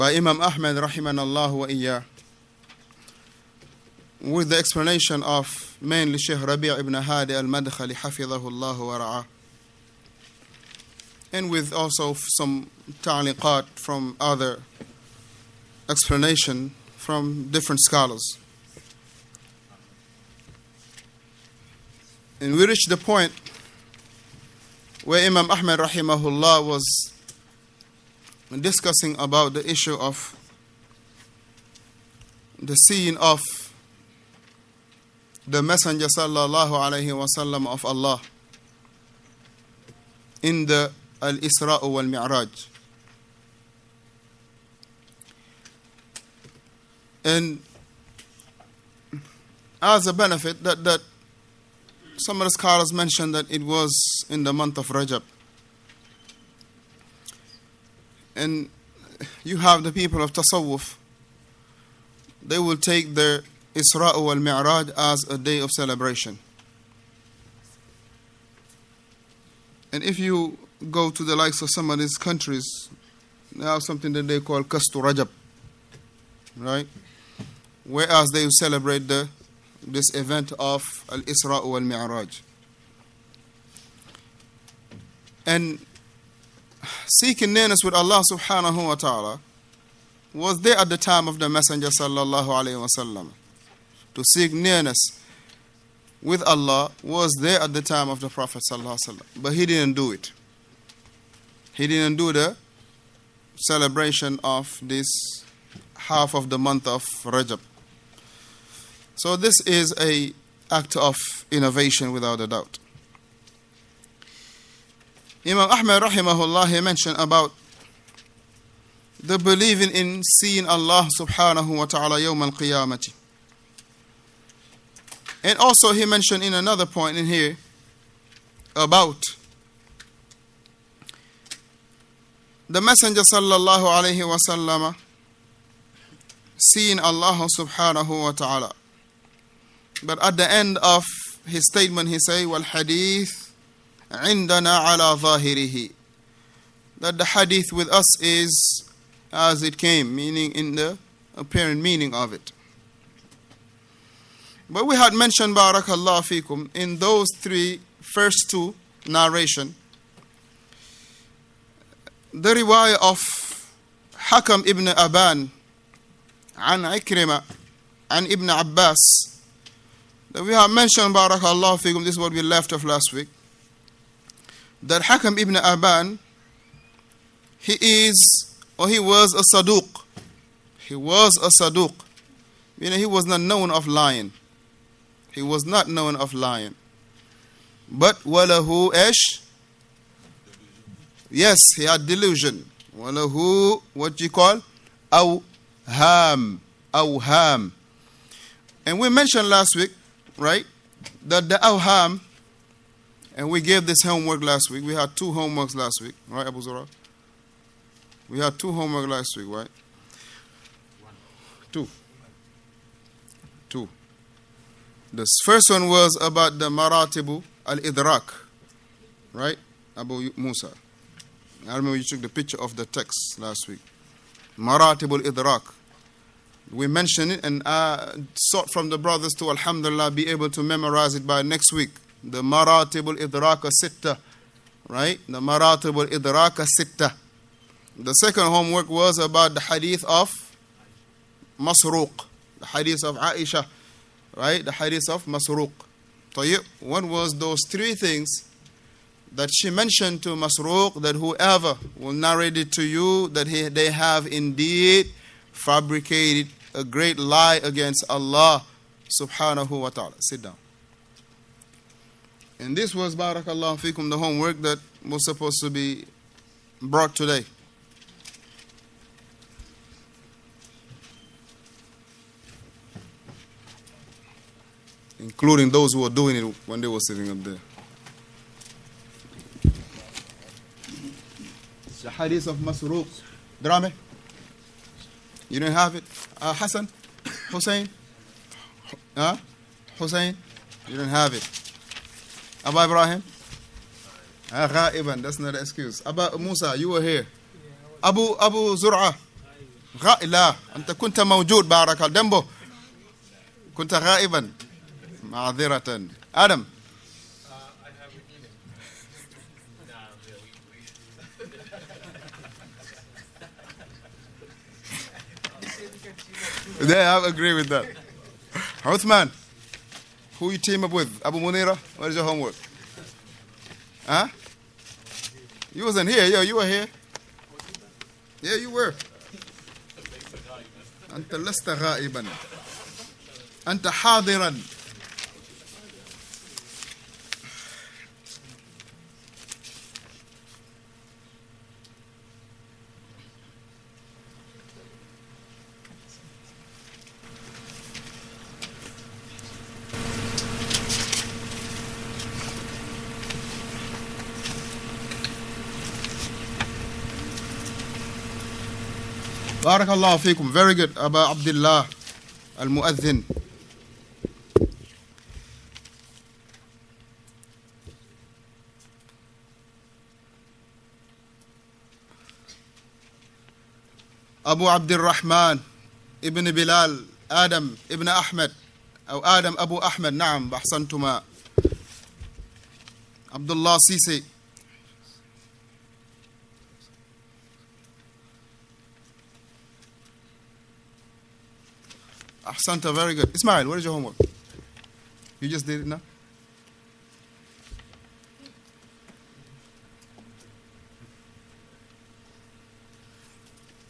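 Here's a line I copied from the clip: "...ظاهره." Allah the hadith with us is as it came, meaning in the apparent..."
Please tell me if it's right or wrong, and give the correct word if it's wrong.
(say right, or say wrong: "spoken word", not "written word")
wrong: "That", not "Allah".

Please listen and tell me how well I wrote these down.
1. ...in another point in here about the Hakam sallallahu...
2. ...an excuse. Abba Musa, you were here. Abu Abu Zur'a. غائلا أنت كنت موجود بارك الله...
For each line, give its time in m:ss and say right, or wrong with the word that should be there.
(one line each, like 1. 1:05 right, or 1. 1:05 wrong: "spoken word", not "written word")
1. 2:06 wrong: "Messenger", not "Hakam"
2. 4:55 right.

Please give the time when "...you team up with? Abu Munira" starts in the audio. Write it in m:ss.
5:20.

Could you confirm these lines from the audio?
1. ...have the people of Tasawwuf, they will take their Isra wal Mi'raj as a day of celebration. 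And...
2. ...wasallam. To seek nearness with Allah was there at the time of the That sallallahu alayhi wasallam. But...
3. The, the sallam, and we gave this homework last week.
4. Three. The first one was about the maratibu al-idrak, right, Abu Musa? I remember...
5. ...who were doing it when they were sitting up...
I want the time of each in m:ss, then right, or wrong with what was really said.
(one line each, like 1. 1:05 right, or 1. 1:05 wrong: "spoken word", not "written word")
1. 0:59 right
2. 1:32 wrong: "Prophet", not "That"
3. 3:21 wrong: "awham", not "sallam"
4. 3:33 wrong: "Two", not "Three"
5. 4:35 right.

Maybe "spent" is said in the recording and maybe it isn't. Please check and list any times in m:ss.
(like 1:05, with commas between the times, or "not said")
not said.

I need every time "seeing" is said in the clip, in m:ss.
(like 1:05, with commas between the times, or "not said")
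0:32, 2:00, 2:16.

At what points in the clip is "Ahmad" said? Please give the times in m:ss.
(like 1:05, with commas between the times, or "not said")
0:25, 1:55.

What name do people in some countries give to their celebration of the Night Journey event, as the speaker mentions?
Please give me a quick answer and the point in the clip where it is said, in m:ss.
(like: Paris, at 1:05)
Kastu Rajab, at 1:14.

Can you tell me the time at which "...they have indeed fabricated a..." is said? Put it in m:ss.
4:13.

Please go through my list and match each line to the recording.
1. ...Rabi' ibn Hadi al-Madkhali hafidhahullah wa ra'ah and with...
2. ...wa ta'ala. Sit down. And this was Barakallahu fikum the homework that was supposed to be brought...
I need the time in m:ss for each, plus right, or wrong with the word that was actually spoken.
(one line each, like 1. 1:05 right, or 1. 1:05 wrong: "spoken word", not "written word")
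1. 0:06 right
2. 4:19 right.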